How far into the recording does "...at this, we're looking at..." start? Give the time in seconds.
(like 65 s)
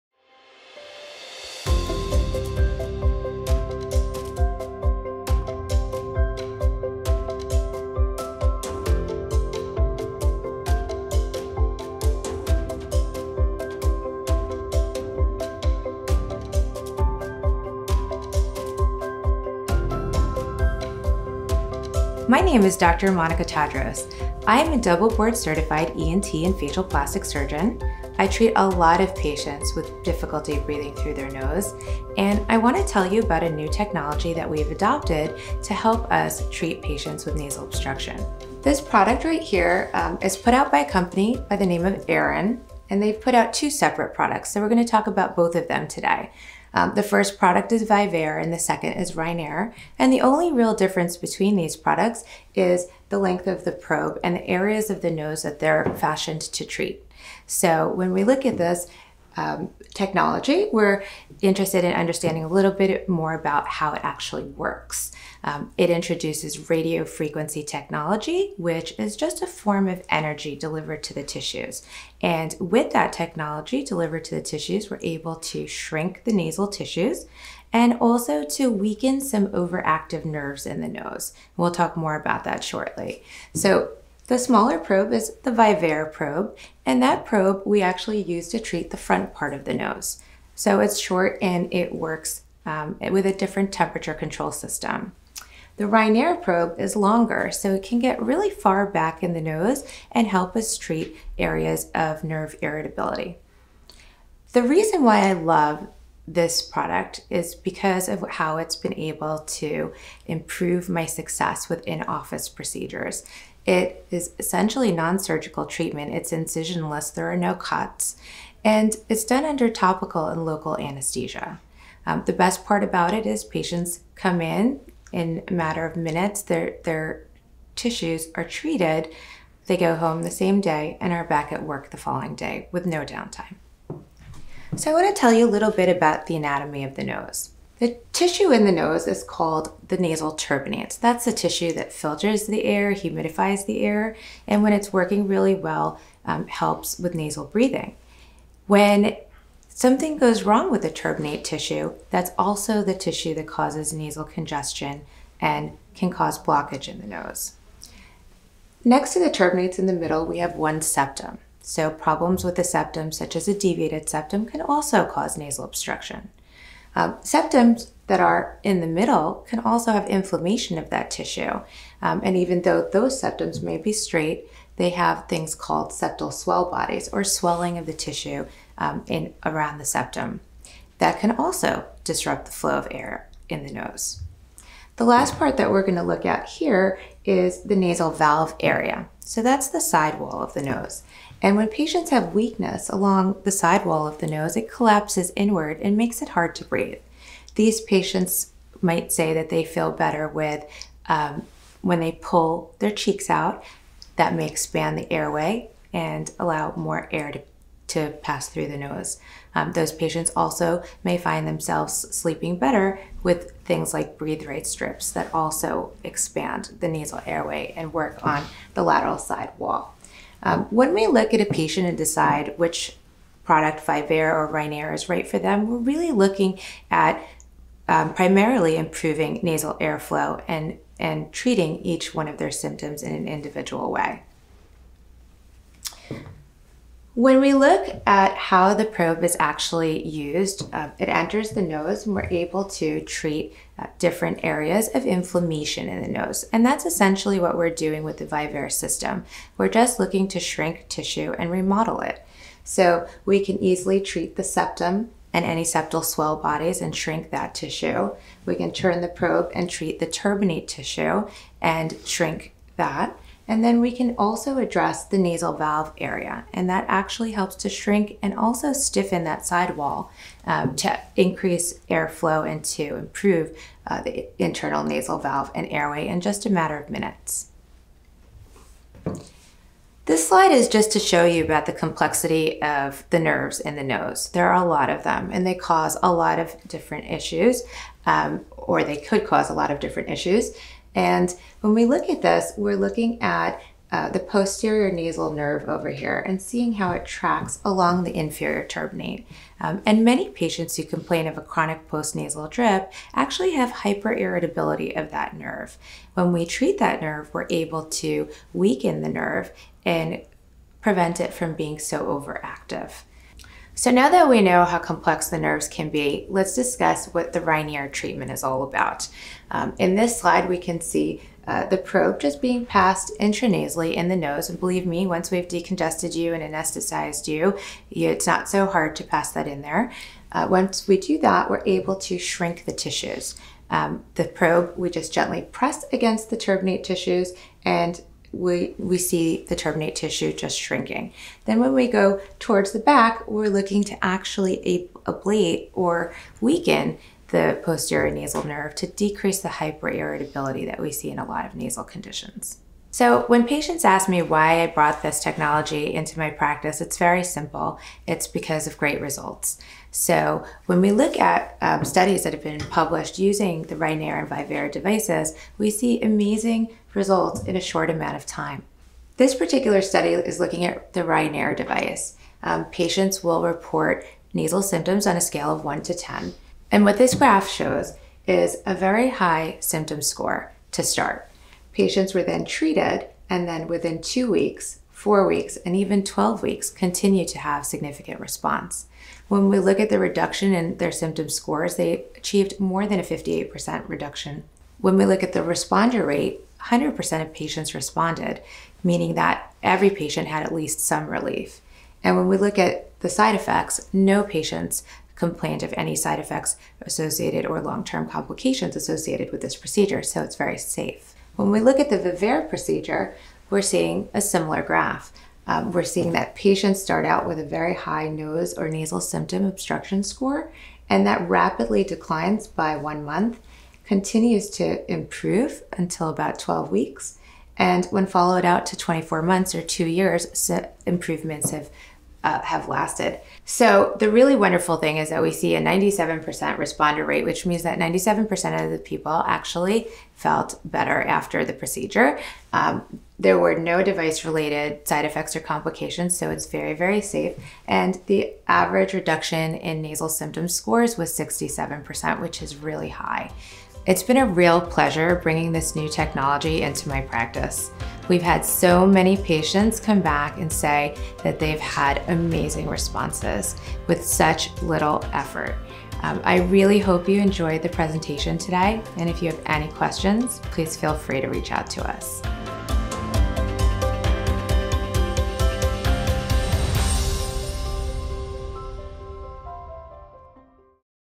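292 s.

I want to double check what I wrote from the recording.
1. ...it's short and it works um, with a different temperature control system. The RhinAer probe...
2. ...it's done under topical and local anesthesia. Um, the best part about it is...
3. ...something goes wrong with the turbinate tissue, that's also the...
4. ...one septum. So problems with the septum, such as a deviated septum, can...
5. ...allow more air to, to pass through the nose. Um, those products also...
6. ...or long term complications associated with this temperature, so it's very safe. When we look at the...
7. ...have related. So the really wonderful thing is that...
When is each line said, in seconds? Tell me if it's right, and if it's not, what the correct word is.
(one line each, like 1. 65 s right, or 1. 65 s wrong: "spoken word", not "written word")
1. 90 s right
2. 119 s right
3. 149 s right
4. 160 s right
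5. 206 s wrong: "patients", not "products"
6. 407 s wrong: "procedure", not "temperature"
7. 432 s wrong: "lasted", not "related".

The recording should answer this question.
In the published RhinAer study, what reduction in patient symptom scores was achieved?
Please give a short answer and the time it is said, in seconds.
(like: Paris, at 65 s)
more than 58%, at 392 s.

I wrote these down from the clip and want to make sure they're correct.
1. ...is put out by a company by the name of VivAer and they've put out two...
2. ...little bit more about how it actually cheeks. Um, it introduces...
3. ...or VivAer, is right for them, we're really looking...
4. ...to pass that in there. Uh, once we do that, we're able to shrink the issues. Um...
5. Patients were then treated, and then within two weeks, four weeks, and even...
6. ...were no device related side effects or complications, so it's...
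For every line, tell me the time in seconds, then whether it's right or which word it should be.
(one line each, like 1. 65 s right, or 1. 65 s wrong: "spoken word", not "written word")
1. 40 s wrong: "Aerin", not "VivAer"
2. 62 s wrong: "works", not "cheeks"
3. 224 s wrong: "RhinAer", not "VivAer"
4. 328 s wrong: "tissues", not "issues"
5. 381 s right
6. 443 s right.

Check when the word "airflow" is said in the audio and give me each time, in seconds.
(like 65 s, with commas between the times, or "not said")
229 s, 271 s.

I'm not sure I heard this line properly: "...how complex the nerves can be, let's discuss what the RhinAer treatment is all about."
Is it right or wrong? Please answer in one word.
right.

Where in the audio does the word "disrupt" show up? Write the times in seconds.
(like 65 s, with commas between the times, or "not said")
182 s.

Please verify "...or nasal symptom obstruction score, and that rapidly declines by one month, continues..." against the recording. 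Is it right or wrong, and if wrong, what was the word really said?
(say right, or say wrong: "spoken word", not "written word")
right.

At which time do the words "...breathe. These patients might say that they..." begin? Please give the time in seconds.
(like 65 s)
196 s.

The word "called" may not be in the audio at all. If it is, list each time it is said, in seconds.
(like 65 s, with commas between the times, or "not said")
139 s, 175 s.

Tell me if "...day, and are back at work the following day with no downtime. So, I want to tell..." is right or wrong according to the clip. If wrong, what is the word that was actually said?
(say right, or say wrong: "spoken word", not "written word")
right.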